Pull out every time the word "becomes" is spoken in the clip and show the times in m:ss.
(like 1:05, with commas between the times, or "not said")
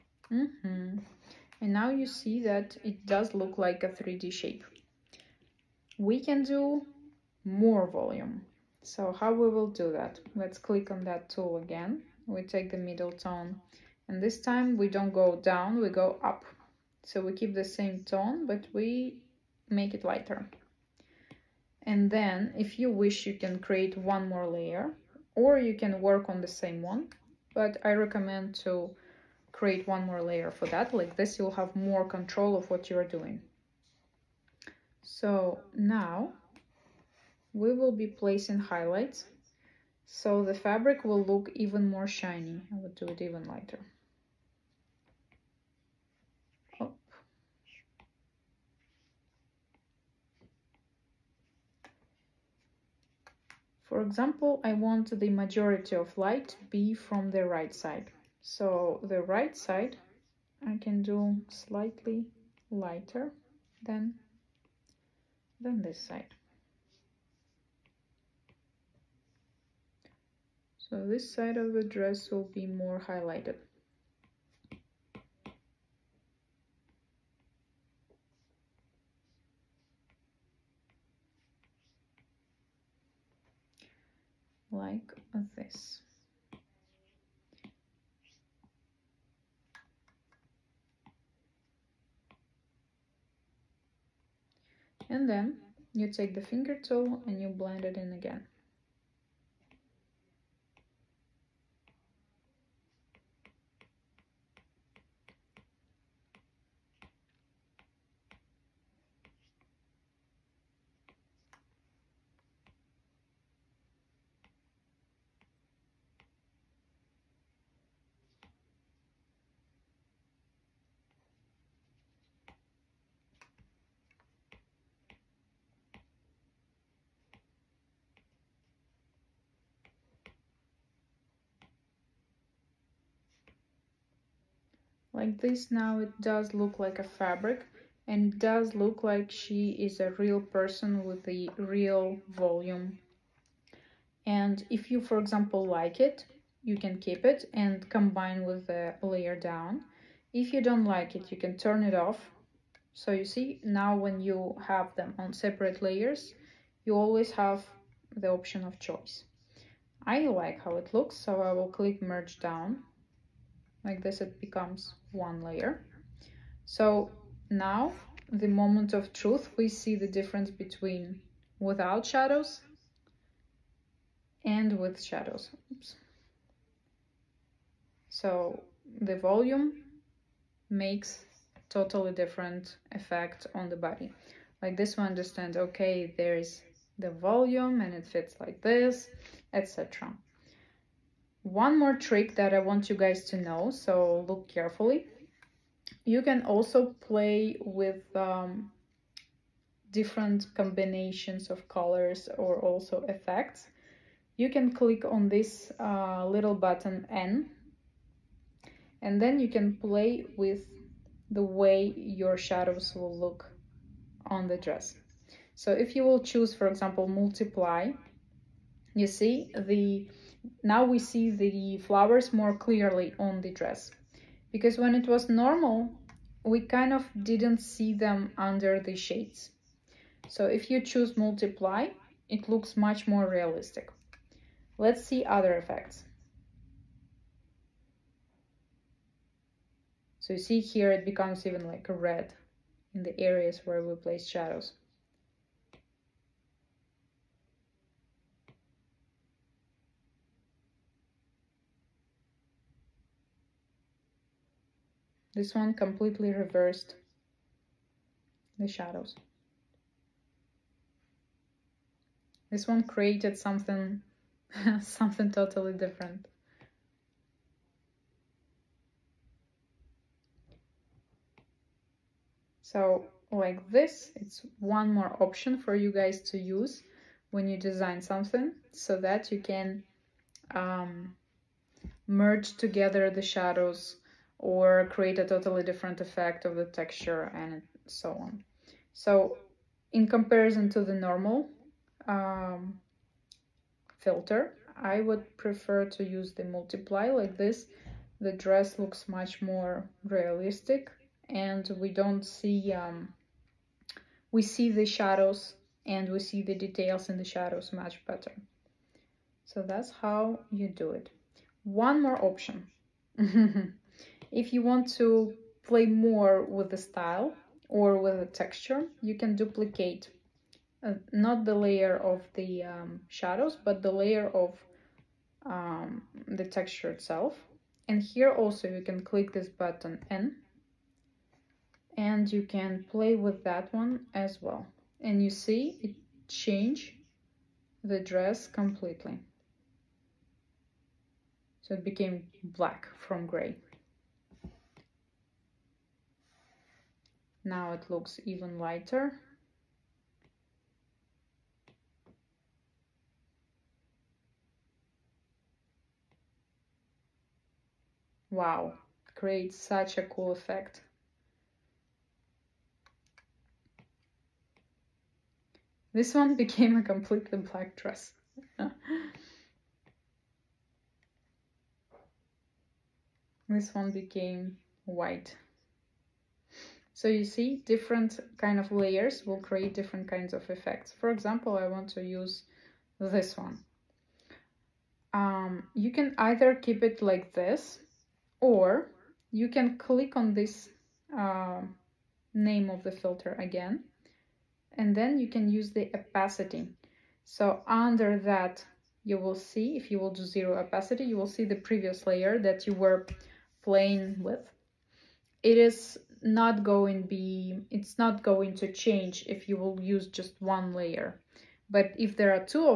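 2:44, 4:01.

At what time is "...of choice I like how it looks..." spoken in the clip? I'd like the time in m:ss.
2:38.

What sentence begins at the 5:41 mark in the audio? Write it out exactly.
So it became black from gray.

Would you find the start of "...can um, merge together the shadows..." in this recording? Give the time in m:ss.
4:39.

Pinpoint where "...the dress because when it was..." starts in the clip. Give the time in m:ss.
3:43.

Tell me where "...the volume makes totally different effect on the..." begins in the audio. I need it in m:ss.
2:59.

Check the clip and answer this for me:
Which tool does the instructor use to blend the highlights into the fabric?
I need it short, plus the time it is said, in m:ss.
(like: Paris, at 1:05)
Finger tool, at 1:36.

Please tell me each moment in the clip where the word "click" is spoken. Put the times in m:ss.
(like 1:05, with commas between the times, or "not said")
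0:10, 2:41, 3:24, 5:29, 6:29.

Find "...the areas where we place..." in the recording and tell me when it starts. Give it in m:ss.
4:03.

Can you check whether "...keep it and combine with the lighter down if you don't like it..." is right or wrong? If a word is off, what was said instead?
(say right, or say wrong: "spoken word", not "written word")
wrong: "layer", not "lighter".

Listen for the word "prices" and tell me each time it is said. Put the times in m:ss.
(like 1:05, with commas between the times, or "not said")
not said.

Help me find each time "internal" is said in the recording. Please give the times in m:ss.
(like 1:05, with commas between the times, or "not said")
not said.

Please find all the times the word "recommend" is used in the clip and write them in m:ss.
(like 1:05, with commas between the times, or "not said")
0:27.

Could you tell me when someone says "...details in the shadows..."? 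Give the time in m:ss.
5:06.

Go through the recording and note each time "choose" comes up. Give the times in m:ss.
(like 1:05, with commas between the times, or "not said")
3:36, 3:50.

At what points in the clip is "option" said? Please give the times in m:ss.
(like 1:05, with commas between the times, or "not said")
2:38, 4:35, 5:12.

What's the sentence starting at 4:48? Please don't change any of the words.
So in comparison to the normal um, filter, I would prefer to use the multiply like this.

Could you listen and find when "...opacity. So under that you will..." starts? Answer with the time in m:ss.
6:35.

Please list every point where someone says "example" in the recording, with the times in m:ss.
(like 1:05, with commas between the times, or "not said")
0:54, 2:25, 3:36, 6:21.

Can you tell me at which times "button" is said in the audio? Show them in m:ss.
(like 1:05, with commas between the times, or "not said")
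3:26, 5:29.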